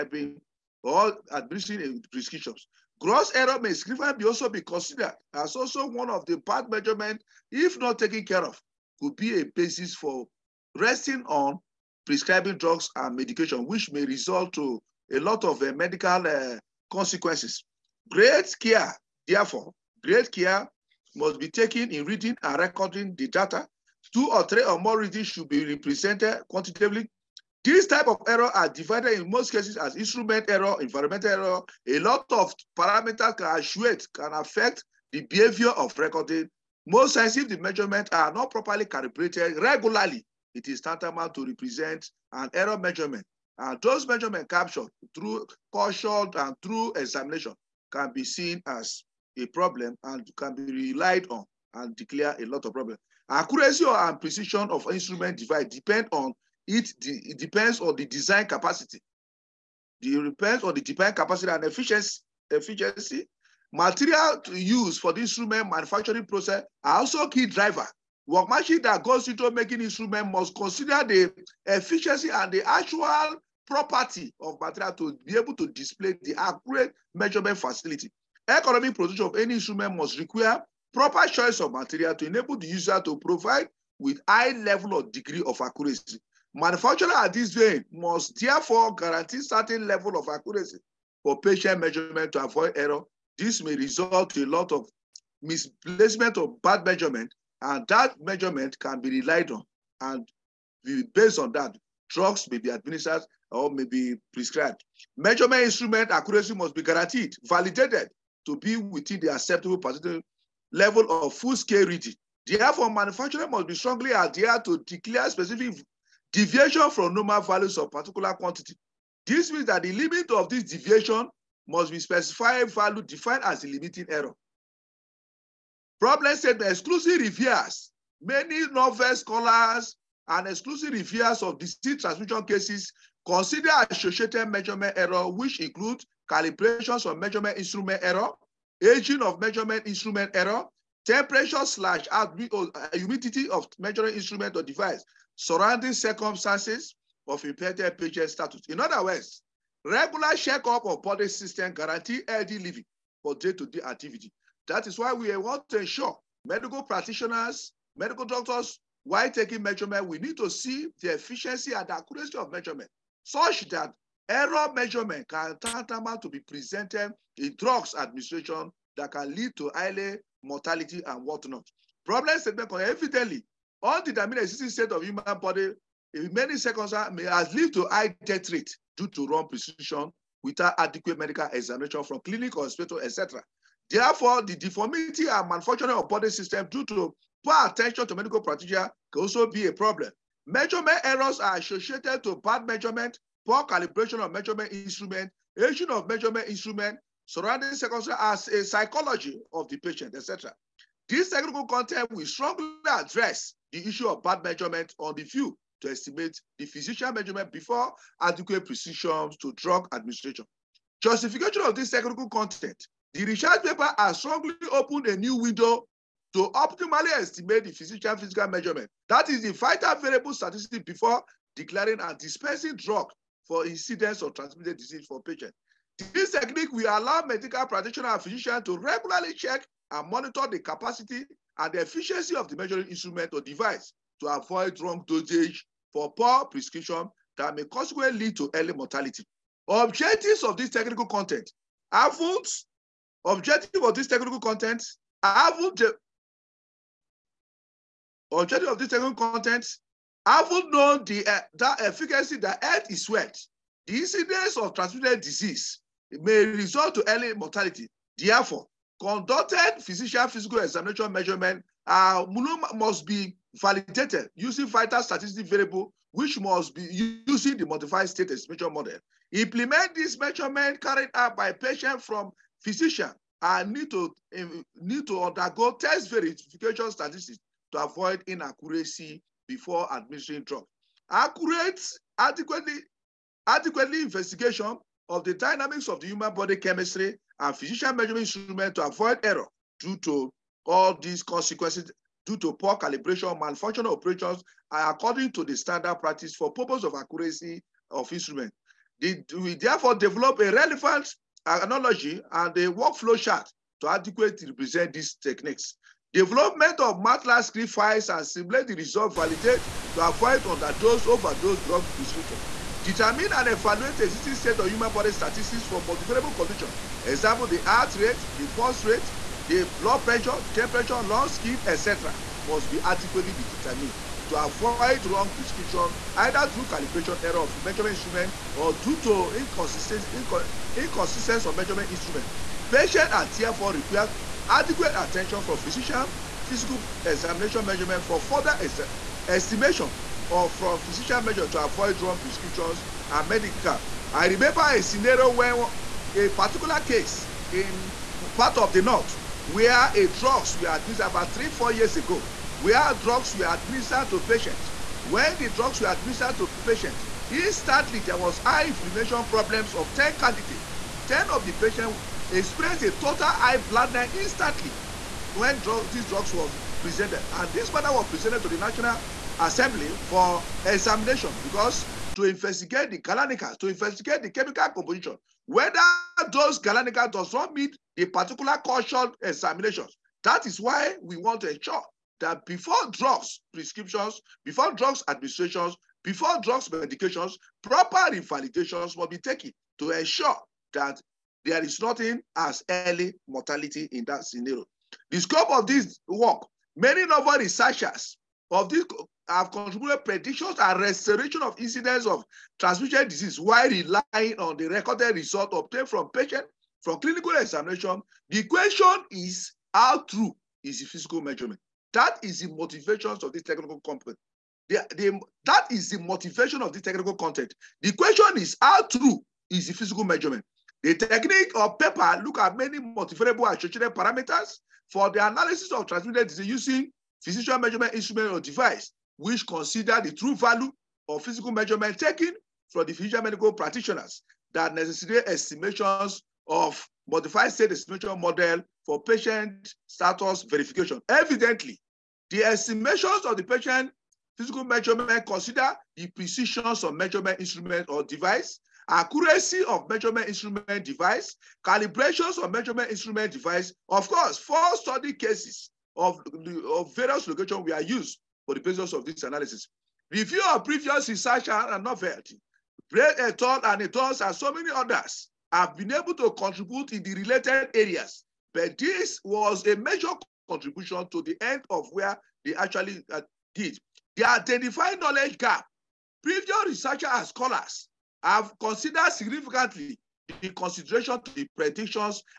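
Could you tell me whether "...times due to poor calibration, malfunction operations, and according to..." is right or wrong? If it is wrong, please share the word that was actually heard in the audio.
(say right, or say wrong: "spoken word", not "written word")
wrong: "consequences", not "times".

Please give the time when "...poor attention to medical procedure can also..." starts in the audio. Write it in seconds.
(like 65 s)
187 s.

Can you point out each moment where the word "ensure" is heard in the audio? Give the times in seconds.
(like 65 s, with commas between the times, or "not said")
155 s, 381 s, 389 s.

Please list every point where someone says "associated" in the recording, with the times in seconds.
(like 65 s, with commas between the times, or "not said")
133 s, 191 s, 423 s.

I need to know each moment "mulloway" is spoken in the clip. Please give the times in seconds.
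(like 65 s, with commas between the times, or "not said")
not said.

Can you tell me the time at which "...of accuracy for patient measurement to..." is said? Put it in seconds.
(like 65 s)
90 s.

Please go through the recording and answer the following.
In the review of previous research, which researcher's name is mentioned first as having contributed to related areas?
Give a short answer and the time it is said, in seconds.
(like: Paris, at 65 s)
Brett, at 462 s.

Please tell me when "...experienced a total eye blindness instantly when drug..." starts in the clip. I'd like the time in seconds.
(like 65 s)
362 s.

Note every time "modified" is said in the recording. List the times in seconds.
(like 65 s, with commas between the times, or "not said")
267 s, 437 s.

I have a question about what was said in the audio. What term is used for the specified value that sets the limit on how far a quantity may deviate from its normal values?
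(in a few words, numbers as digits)
limiting error.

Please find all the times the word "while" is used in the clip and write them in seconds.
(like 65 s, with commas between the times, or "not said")
159 s, 403 s.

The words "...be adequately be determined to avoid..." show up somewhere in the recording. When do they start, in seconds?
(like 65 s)
322 s.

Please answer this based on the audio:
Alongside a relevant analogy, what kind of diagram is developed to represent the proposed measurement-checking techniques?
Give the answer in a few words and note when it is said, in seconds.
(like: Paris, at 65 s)
workflow chart, at 302 s.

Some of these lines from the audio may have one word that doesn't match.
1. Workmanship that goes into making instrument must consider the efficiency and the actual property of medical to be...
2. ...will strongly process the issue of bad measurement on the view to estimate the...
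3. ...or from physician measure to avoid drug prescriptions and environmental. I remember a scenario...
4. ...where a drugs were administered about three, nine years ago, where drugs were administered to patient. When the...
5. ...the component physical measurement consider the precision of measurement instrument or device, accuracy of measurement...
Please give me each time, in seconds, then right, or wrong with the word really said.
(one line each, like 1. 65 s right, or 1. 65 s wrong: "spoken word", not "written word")
1. 68 s wrong: "material", not "medical"
2. 202 s wrong: "address", not "process"
3. 340 s wrong: "medical", not "environmental"
4. 349 s wrong: "four", not "nine"
5. 443 s wrong: "patient", not "component".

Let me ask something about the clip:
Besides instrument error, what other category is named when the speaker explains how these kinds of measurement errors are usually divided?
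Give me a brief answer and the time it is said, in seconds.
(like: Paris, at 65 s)
environmental error, at 30 s.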